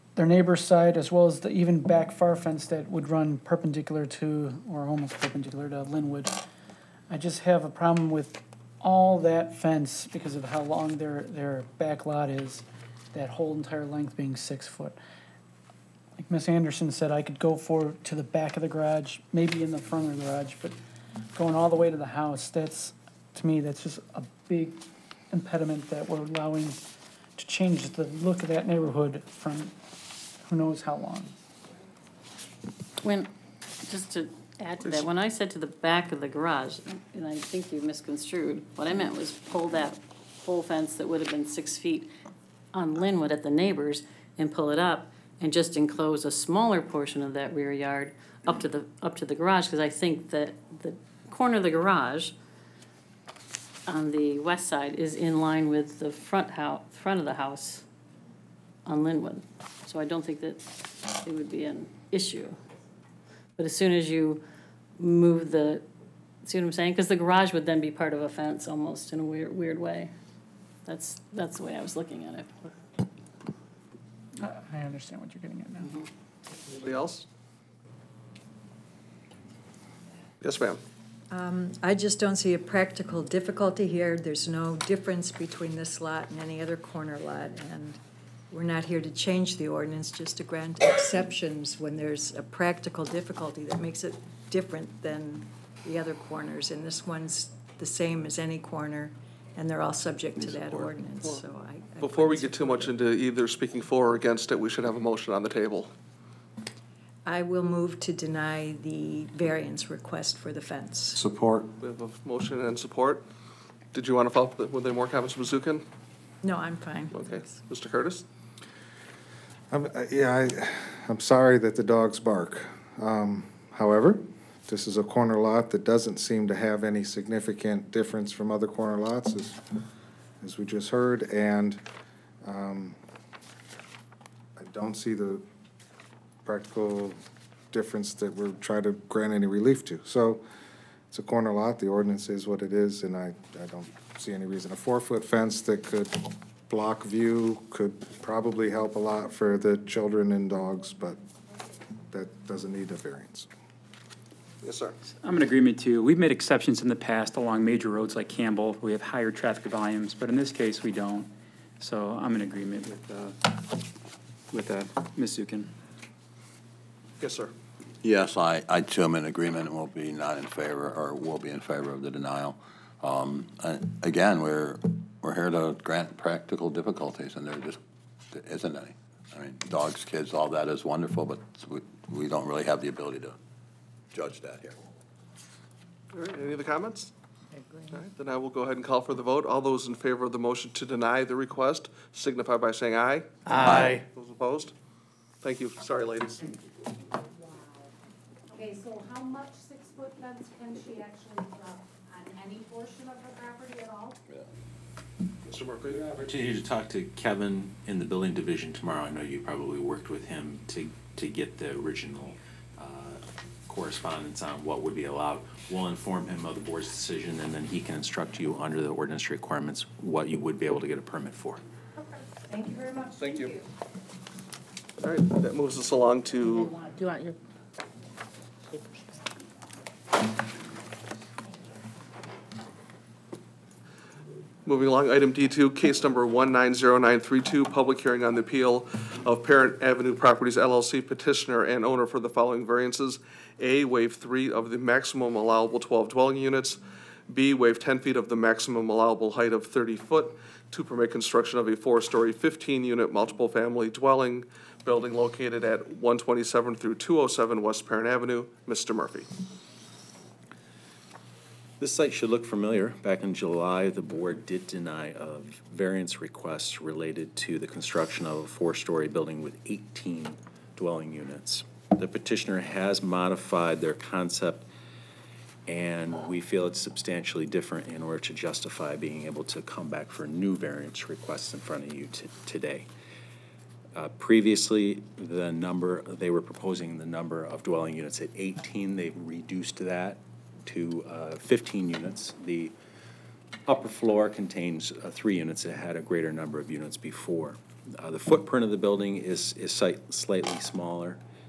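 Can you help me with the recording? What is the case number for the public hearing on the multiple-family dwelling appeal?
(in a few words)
190932.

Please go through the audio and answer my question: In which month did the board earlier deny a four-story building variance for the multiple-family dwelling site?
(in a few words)
July.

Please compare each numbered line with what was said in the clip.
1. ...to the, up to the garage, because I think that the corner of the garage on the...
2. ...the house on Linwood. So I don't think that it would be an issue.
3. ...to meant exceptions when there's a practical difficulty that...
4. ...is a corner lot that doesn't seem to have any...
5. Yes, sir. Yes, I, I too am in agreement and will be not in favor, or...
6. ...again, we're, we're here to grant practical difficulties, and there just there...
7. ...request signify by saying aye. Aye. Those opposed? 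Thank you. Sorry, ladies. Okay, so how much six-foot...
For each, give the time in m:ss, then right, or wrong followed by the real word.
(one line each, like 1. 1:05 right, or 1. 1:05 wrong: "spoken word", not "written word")
1. 0:48 right
2. 0:57 right
3. 1:30 wrong: "grant", not "meant"
4. 2:04 right
5. 2:47 right
6. 2:54 right
7. 3:11 right.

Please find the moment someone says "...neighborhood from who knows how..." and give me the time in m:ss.
0:28.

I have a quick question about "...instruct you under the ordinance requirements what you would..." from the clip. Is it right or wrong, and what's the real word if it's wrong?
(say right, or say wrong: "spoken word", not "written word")
right.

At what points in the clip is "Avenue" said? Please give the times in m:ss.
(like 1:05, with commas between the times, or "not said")
3:59, 4:18.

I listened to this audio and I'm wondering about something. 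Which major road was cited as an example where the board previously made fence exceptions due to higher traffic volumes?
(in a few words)
Campbell.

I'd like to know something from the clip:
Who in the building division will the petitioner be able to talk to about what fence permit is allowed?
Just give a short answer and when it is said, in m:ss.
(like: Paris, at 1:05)
Kevin, at 3:27.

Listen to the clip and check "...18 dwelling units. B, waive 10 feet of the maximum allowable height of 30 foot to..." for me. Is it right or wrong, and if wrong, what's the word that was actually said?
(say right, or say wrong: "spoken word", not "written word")
wrong: "12", not "18".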